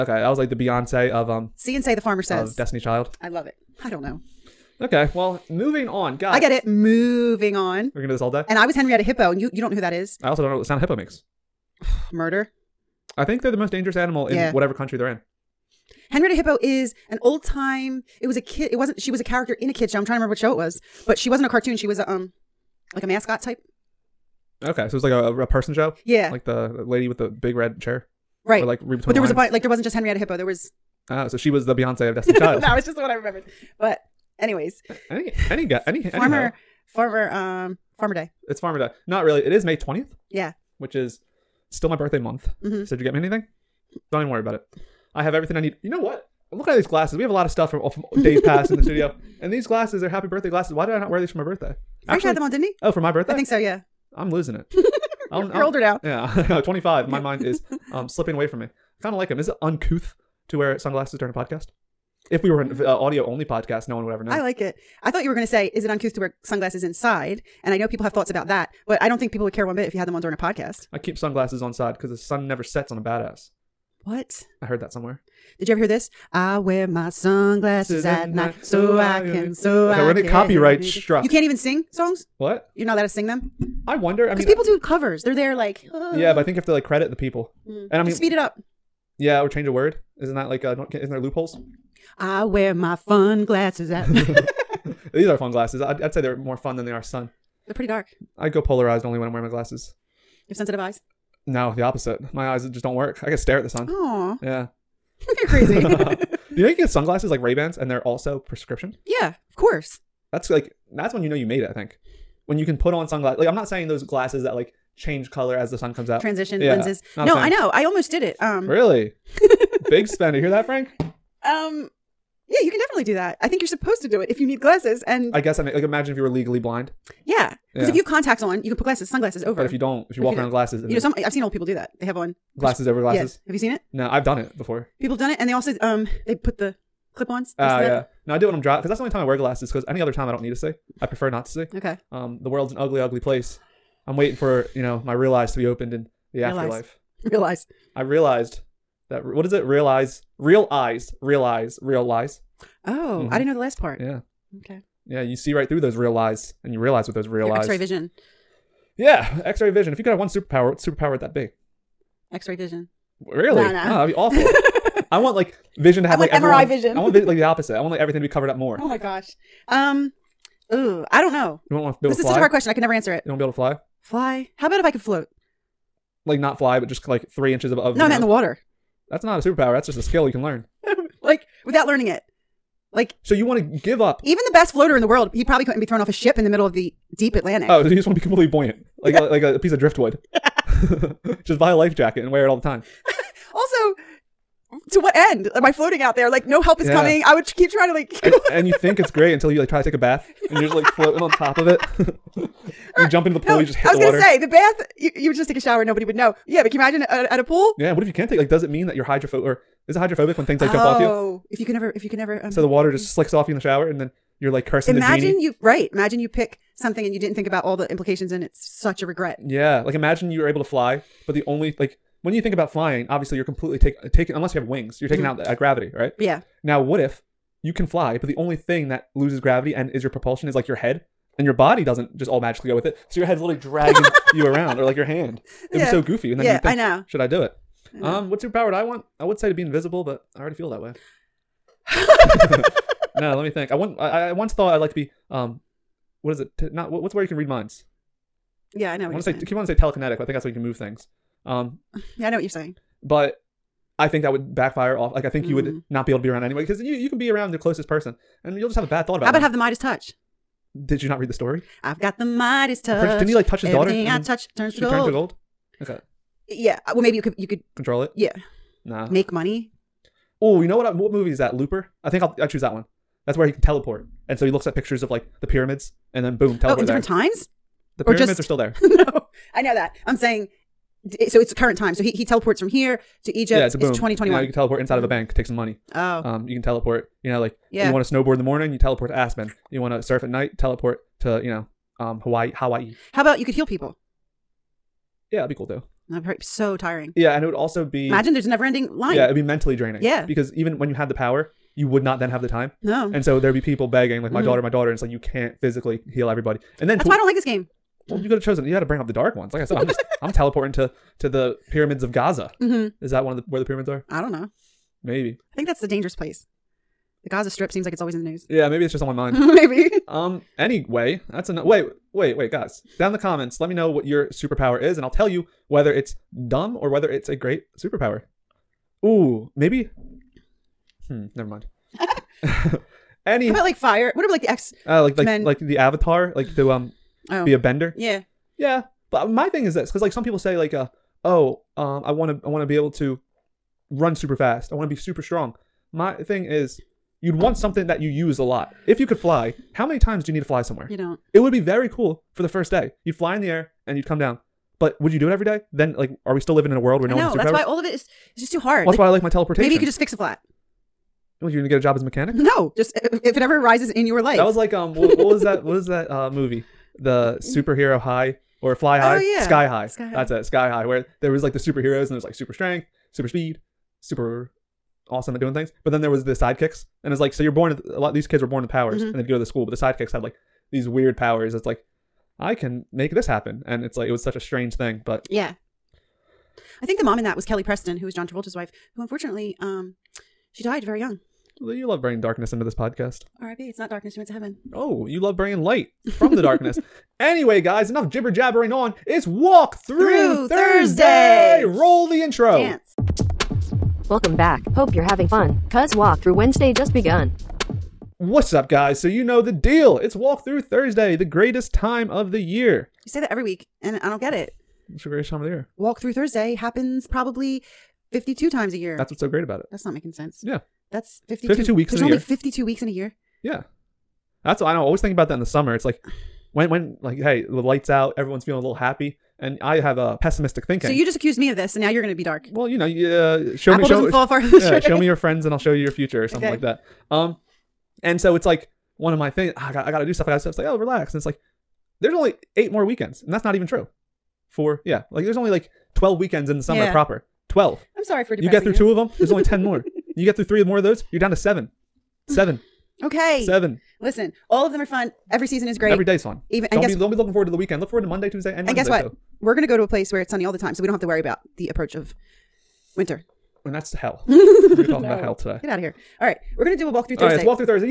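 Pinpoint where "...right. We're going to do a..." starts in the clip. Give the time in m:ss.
7:46.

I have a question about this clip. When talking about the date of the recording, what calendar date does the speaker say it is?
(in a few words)
May 20.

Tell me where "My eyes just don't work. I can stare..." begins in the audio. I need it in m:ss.
1:42.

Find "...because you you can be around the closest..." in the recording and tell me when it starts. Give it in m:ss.
4:16.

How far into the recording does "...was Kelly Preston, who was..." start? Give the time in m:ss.
6:27.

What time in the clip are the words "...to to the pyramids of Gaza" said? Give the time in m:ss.
5:10.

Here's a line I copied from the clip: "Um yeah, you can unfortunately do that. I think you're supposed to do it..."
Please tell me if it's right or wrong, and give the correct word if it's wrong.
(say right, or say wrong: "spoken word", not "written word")
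wrong: "definitely", not "unfortunately".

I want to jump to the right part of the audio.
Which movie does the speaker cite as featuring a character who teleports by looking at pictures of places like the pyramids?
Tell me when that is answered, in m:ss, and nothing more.
4:31.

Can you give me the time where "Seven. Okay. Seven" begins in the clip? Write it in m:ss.
7:32.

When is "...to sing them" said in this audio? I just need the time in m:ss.
1:23.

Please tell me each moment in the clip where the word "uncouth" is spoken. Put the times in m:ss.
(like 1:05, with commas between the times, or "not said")
0:59, 1:05.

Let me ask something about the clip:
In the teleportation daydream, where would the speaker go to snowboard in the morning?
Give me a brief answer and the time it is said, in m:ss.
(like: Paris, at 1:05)
Aspen, at 4:49.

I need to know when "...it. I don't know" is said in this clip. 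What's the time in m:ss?
0:03.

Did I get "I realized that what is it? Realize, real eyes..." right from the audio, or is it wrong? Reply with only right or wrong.
right.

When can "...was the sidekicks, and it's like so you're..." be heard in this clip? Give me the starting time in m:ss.
6:16.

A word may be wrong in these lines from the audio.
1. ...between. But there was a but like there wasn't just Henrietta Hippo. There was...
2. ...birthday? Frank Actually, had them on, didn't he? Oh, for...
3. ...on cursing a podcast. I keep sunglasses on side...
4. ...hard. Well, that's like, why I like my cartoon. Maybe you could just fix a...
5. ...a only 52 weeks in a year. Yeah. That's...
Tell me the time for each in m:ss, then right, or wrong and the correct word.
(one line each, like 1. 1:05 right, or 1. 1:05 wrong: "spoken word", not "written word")
1. 0:28 right
2. 0:51 right
3. 1:10 wrong: "during", not "cursing"
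4. 5:58 wrong: "teleportation", not "cartoon"
5. 7:02 right.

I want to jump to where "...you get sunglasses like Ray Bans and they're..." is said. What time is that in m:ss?
1:46.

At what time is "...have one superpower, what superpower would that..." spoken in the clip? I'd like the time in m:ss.
2:40.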